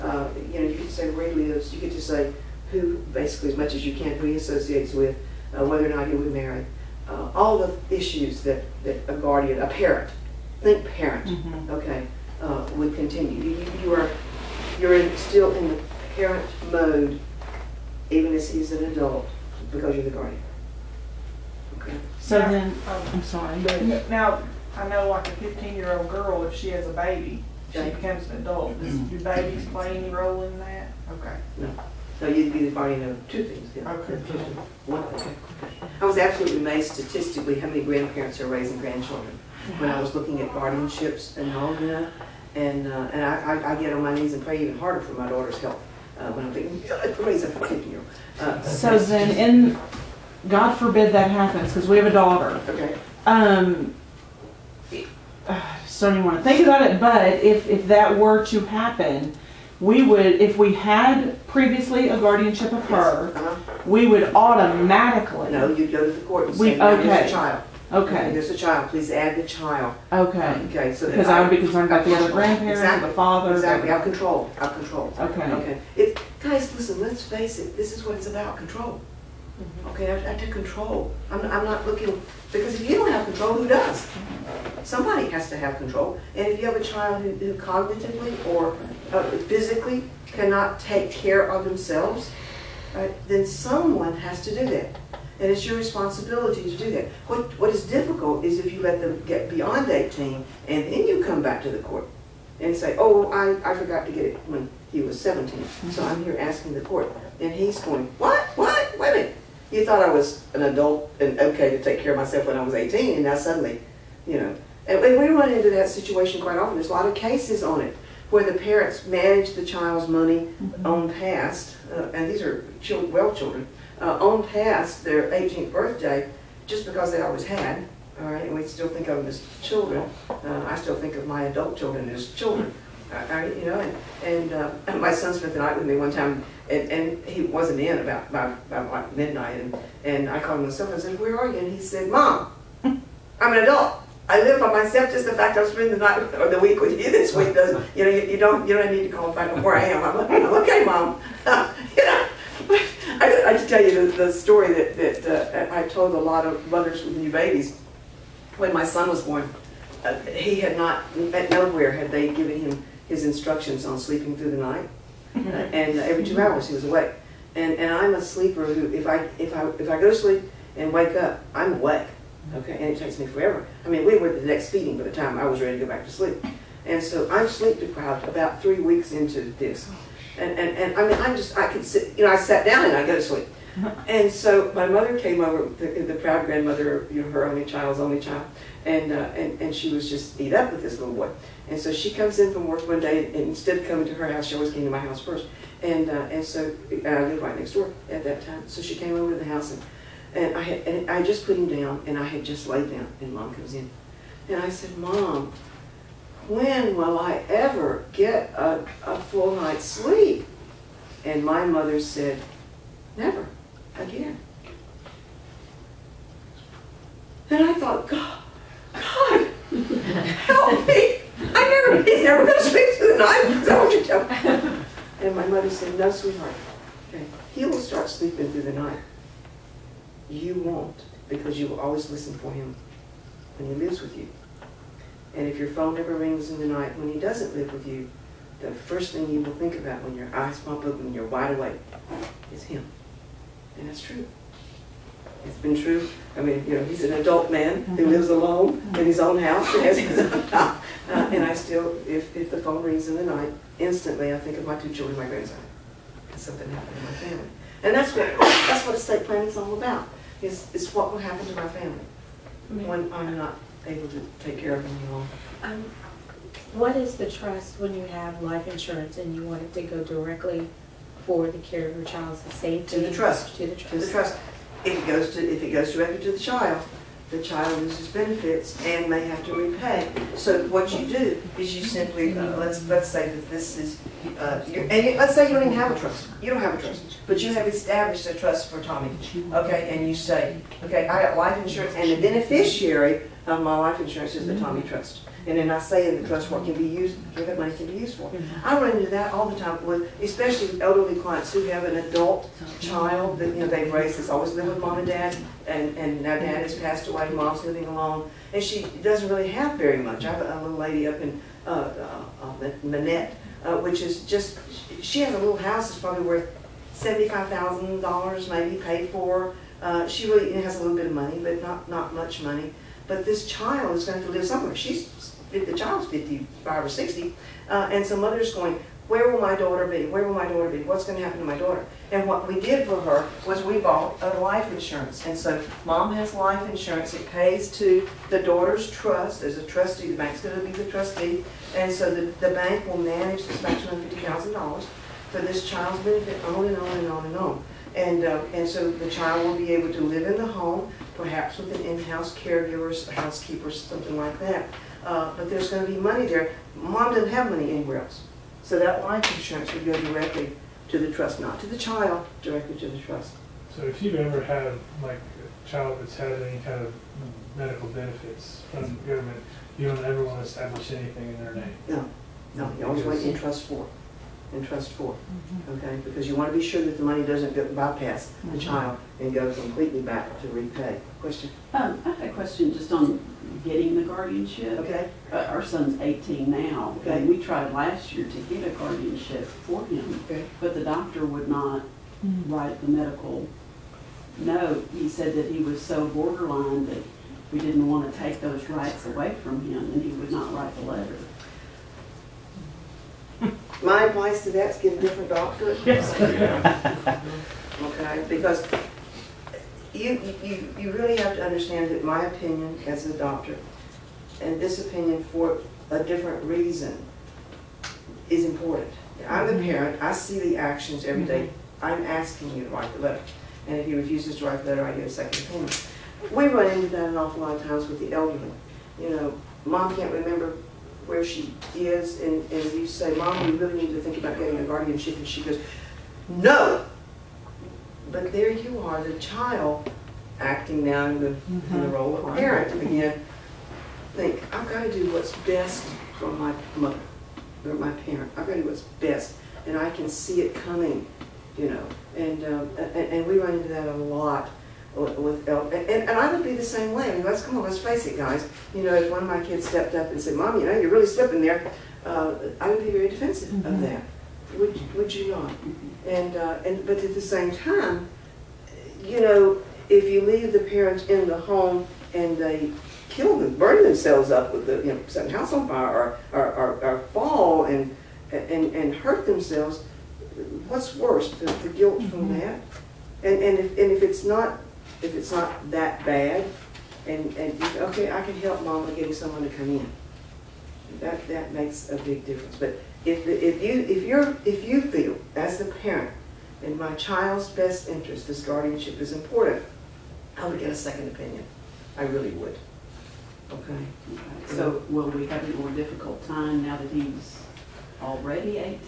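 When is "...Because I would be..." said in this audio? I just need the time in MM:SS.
01:11.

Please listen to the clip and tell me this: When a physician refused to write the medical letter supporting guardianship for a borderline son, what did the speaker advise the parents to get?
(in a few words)
a different doctor.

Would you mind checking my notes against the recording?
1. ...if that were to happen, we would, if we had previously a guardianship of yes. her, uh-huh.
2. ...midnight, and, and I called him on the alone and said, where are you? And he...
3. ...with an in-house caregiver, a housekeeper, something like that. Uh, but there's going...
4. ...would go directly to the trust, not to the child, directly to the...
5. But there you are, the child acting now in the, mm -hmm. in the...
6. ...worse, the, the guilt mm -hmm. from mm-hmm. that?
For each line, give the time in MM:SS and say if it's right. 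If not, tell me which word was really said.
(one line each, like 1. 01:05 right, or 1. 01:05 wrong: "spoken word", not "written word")
1. 00:57 right
2. 02:19 wrong: "phone", not "alone"
3. 05:51 right
4. 05:59 right
5. 07:18 right
6. 08:00 right.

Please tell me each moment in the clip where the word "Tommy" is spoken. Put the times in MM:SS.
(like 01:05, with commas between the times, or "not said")
04:48, 04:54.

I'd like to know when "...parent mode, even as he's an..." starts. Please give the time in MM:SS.
00:16.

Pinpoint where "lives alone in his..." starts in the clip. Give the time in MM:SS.
04:08.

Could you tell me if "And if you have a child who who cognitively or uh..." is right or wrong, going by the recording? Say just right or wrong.
right.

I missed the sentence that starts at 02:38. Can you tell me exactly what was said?
When my son was born, uh, he had not, at nowhere had they given him his instructions on sleeping through the night.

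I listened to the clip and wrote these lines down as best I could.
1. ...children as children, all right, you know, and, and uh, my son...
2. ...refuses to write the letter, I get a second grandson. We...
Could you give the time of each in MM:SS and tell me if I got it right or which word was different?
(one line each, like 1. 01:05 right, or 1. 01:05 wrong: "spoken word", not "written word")
1. 02:11 right
2. 07:03 wrong: "opinion", not "grandson".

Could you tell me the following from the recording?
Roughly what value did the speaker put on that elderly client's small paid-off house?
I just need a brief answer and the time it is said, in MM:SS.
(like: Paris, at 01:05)
$75,000, at 05:16.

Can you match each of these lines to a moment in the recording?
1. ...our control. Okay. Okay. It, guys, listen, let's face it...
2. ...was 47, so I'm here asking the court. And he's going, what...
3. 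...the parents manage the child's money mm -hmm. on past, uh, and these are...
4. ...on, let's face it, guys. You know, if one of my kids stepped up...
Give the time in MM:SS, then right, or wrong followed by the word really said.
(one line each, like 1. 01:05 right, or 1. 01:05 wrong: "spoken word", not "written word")
1. 01:14 right
2. 01:45 wrong: "17", not "47"
3. 01:58 right
4. 07:37 right.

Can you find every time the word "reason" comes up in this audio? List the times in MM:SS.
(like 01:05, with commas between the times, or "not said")
06:56.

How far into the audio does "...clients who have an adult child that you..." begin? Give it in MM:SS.
05:01.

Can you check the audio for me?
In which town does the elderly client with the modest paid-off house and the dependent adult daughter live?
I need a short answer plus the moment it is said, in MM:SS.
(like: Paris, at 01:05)
Monette, at 05:12.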